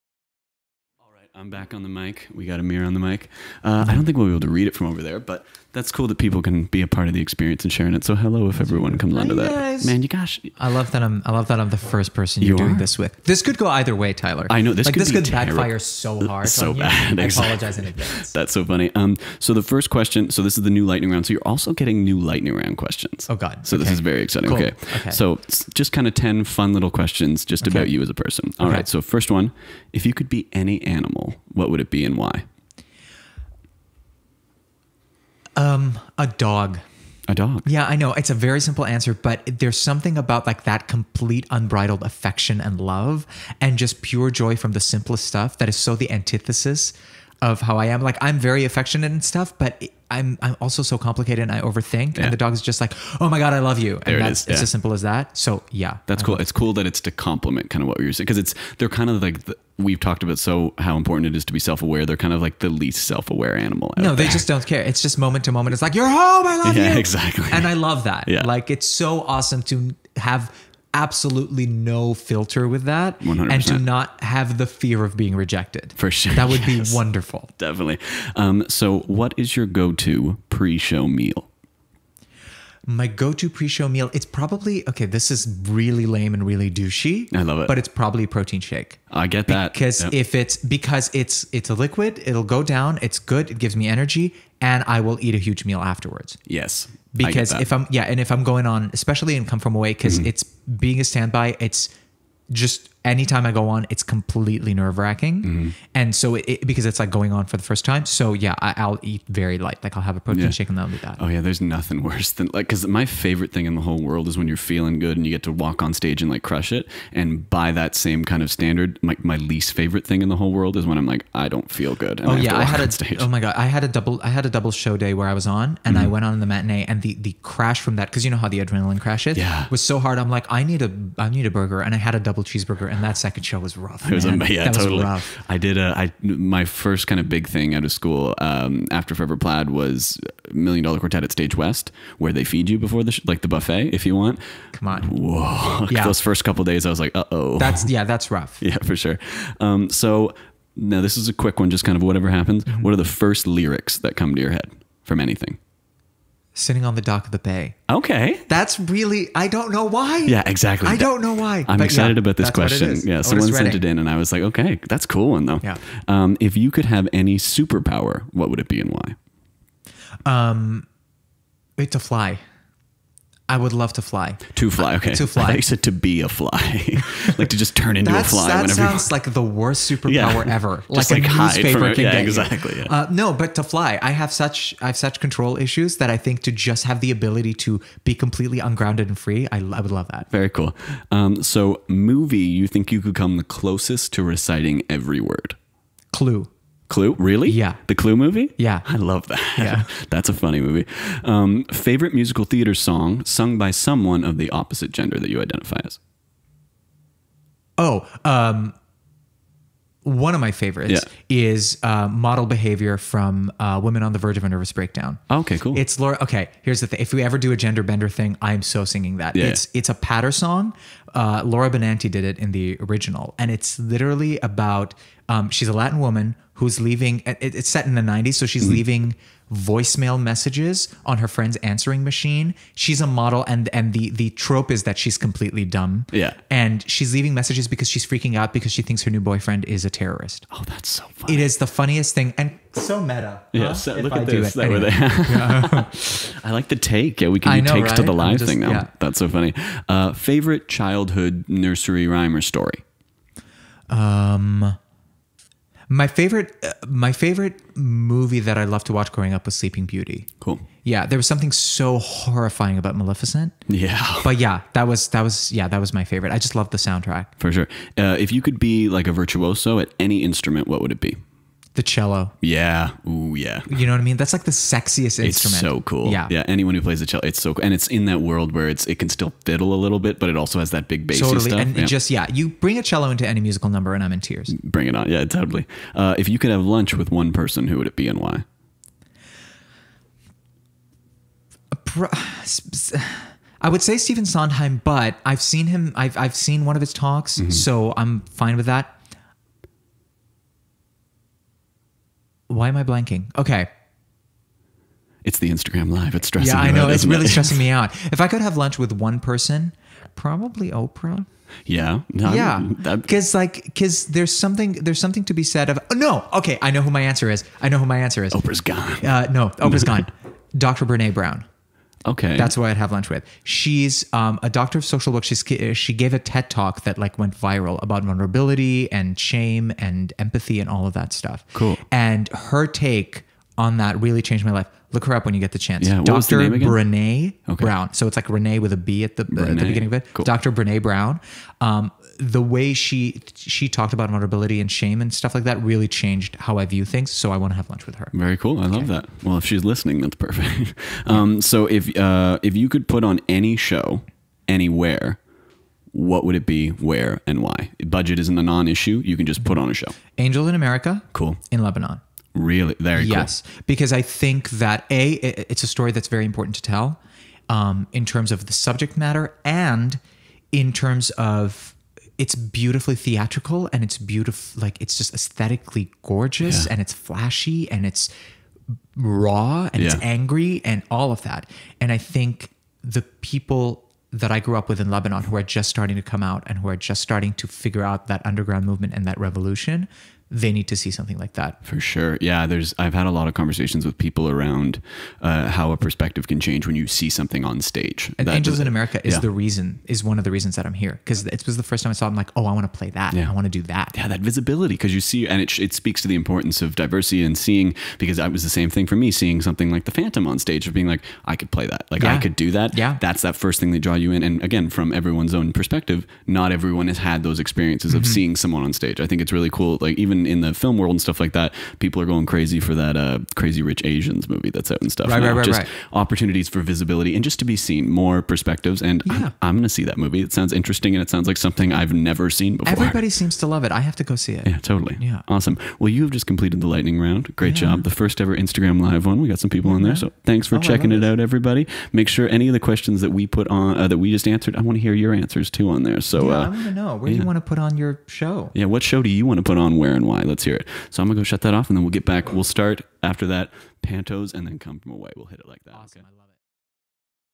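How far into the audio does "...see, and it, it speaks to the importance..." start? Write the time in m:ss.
6:45.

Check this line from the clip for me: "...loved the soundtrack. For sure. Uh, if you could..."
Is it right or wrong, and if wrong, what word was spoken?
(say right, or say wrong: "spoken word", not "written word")
right.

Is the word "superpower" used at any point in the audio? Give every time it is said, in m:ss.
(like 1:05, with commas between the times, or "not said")
2:47, 2:59.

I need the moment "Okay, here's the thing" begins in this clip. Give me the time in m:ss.
3:36.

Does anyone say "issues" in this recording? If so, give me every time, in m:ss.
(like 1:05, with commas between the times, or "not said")
3:05, 5:58.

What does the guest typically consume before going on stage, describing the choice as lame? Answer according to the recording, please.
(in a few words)
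Protein shake.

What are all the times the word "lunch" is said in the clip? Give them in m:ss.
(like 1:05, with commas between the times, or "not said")
4:46, 5:08, 5:22, 5:47.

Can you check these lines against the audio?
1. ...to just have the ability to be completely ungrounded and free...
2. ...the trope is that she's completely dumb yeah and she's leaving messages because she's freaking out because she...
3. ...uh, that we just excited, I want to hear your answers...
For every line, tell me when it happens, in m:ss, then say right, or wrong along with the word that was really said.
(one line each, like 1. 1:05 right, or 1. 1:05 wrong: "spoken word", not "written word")
1. 3:06 right
2. 3:54 right
3. 7:23 wrong: "answered", not "excited".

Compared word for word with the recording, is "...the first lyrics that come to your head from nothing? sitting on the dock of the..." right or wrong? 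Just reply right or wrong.
wrong.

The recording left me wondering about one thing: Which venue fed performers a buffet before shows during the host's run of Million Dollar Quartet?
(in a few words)
Stage West.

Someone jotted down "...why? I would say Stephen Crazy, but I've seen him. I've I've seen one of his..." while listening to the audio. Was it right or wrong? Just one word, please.
wrong.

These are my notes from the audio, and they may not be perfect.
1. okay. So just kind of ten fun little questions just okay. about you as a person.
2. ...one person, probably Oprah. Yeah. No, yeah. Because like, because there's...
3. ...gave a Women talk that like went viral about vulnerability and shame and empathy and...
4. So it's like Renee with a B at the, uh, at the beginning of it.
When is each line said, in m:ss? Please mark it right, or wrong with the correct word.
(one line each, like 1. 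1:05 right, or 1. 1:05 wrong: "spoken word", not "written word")
1. 0:24 right
2. 5:08 right
3. 5:25 wrong: "TED", not "Women"
4. 5:37 right.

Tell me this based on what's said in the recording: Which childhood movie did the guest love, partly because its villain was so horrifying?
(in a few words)
Sleeping Beauty.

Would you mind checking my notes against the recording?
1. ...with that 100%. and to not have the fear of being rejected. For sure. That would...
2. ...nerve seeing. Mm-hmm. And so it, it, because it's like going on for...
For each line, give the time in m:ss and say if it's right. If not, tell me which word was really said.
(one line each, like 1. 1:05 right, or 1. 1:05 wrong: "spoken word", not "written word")
1. 1:12 right
2. 1:44 wrong: "wracking", not "seeing".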